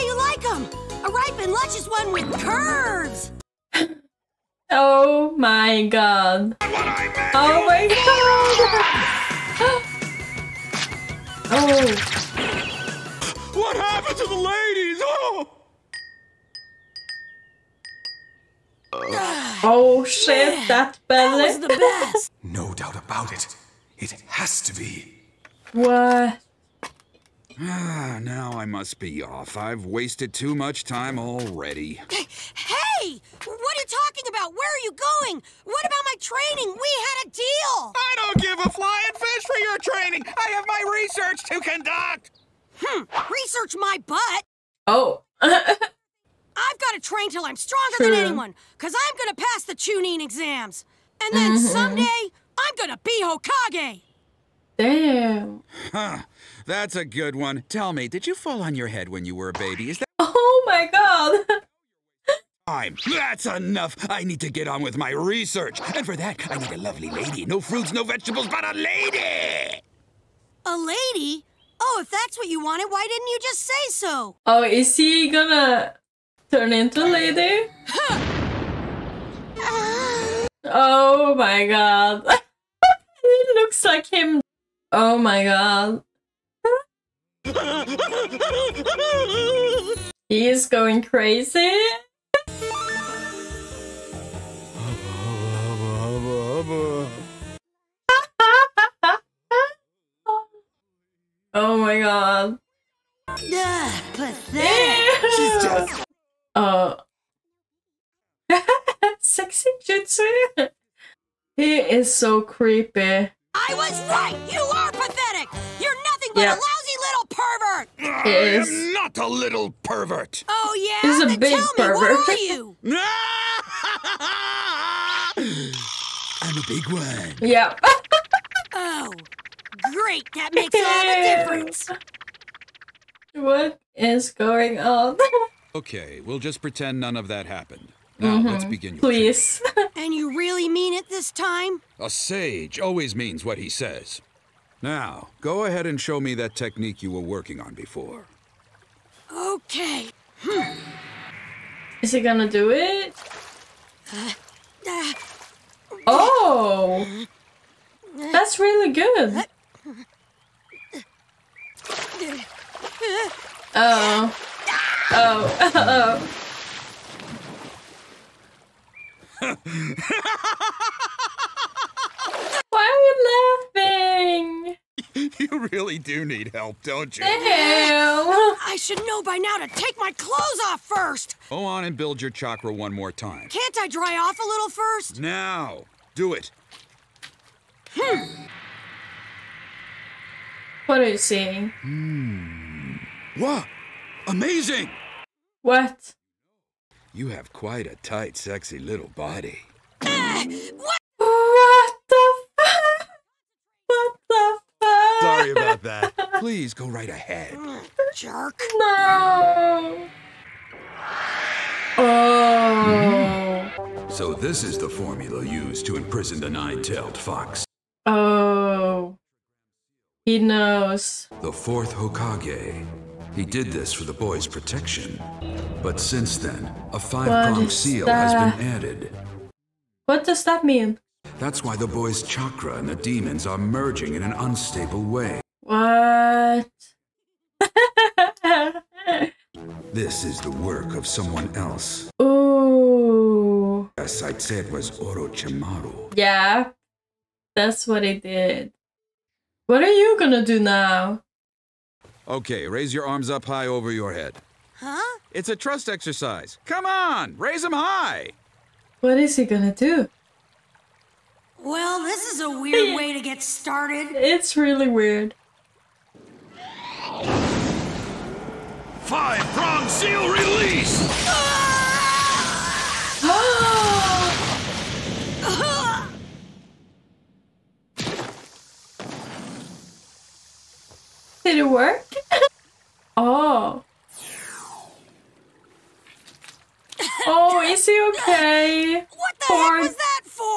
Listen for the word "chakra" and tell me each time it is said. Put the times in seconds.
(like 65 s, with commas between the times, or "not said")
182 s, 232 s.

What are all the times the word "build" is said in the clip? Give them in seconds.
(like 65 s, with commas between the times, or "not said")
181 s.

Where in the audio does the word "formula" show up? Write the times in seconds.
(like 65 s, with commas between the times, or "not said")
214 s.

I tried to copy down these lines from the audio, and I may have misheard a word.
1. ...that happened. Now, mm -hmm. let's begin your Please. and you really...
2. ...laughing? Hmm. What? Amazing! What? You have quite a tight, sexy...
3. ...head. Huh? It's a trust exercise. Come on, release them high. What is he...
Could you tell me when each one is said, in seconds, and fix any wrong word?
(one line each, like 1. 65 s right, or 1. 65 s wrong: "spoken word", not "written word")
1. 137 s right
2. 191 s wrong: "seeing", not "laughing"
3. 254 s wrong: "raise", not "release".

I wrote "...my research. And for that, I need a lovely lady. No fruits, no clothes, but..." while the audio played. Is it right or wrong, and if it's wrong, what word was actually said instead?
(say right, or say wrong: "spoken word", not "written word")
wrong: "vegetables", not "clothes".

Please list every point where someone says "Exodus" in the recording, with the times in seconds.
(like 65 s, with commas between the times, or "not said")
not said.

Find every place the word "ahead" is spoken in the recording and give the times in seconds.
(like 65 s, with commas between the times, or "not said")
145 s, 207 s.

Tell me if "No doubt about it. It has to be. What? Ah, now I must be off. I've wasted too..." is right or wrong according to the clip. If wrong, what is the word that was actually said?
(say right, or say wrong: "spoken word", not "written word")
right.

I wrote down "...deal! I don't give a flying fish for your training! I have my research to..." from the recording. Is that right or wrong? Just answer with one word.
right.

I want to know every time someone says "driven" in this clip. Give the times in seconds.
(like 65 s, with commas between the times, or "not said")
not said.